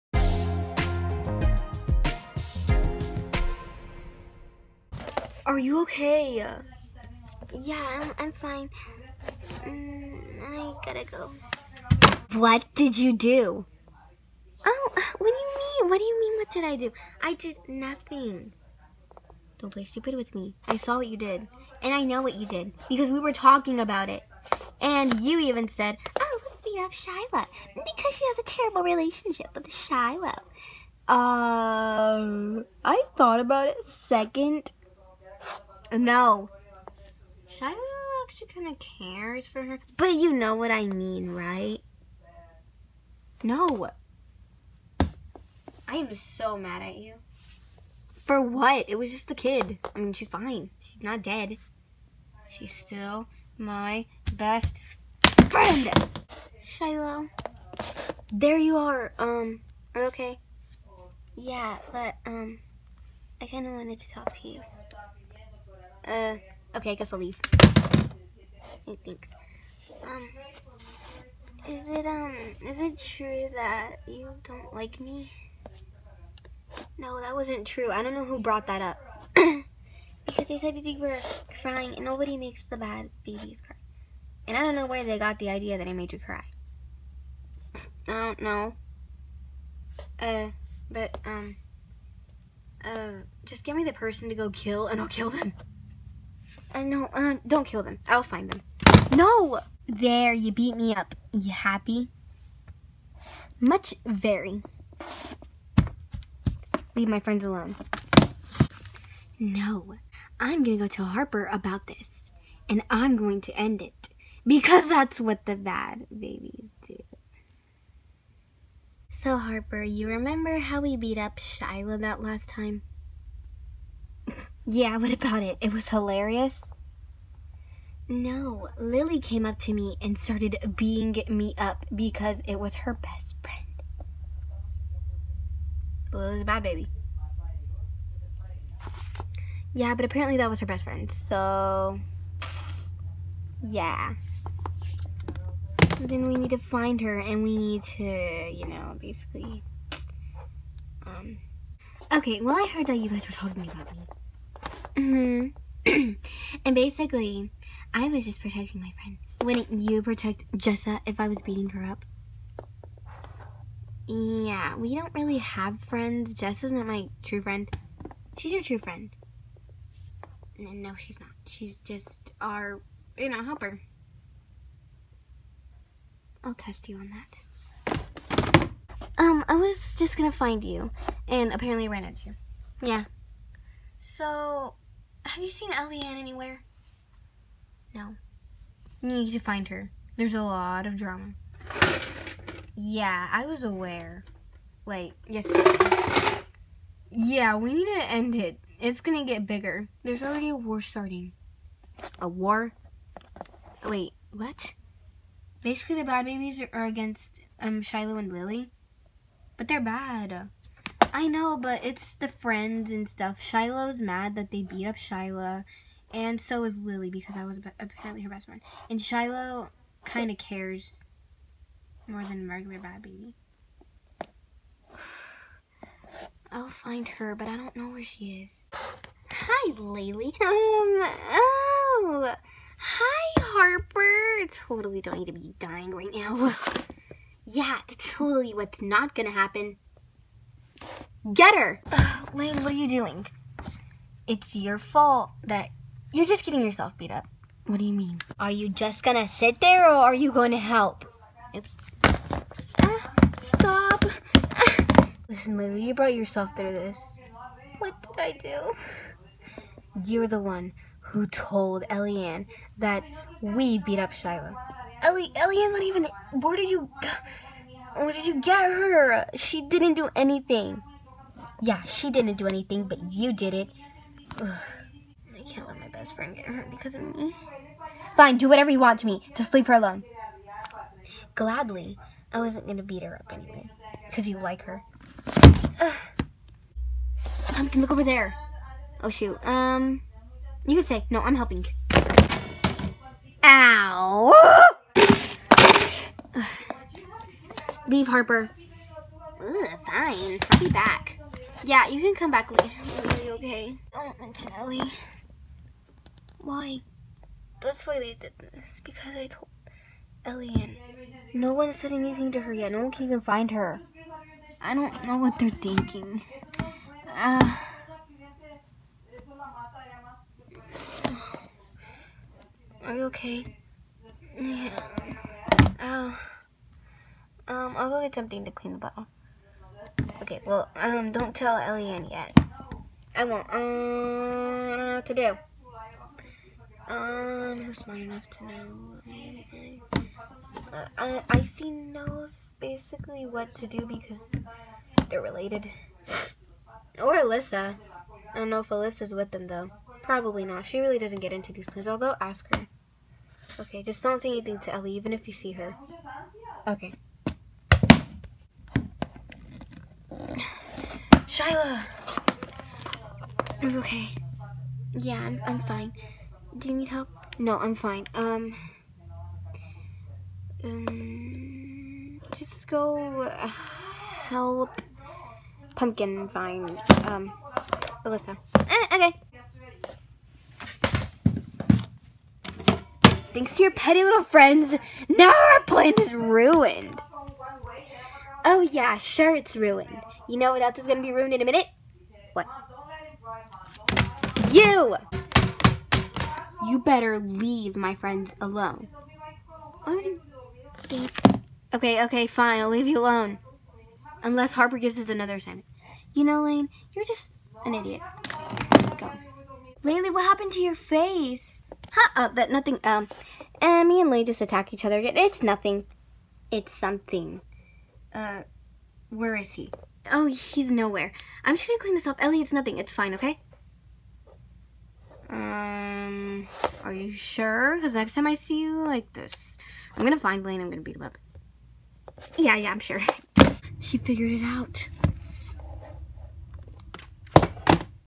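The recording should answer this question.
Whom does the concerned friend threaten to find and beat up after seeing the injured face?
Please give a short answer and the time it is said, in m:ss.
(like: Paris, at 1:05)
Blaine, at 7:09.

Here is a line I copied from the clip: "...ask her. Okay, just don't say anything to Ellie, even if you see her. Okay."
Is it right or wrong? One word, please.
right.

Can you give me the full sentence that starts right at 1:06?
Uh, okay, I guess I'll leave.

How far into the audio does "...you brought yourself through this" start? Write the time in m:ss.
4:15.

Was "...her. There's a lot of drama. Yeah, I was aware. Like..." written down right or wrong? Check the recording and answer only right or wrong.
right.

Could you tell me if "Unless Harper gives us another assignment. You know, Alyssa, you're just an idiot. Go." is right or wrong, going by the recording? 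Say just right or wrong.
wrong.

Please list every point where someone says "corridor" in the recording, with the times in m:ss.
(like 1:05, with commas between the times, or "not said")
not said.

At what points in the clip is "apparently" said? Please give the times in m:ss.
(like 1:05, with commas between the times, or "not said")
2:20, 3:01, 3:37.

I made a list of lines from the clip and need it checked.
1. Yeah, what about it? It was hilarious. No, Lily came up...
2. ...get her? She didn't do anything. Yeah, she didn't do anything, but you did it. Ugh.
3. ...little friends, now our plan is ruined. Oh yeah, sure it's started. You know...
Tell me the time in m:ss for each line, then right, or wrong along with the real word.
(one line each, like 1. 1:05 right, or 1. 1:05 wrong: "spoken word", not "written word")
1. 2:04 right
2. 4:28 right
3. 6:24 wrong: "ruined", not "started".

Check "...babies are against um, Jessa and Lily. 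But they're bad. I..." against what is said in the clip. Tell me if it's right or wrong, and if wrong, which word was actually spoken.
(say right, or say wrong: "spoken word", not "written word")
wrong: "Shiloh", not "Jessa".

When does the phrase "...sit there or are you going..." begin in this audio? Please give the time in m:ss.
4:09.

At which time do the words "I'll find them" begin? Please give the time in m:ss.
1:38.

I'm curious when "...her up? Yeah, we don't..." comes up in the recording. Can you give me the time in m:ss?
2:41.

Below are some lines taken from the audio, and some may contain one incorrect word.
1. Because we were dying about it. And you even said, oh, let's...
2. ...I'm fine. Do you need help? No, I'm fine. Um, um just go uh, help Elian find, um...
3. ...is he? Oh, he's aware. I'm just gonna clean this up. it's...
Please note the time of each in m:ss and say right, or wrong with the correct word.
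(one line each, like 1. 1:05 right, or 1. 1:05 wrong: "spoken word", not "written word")
1. 0:22 wrong: "talking", not "dying"
2. 6:05 wrong: "Pumpkin", not "Elian"
3. 6:59 wrong: "nowhere", not "aware".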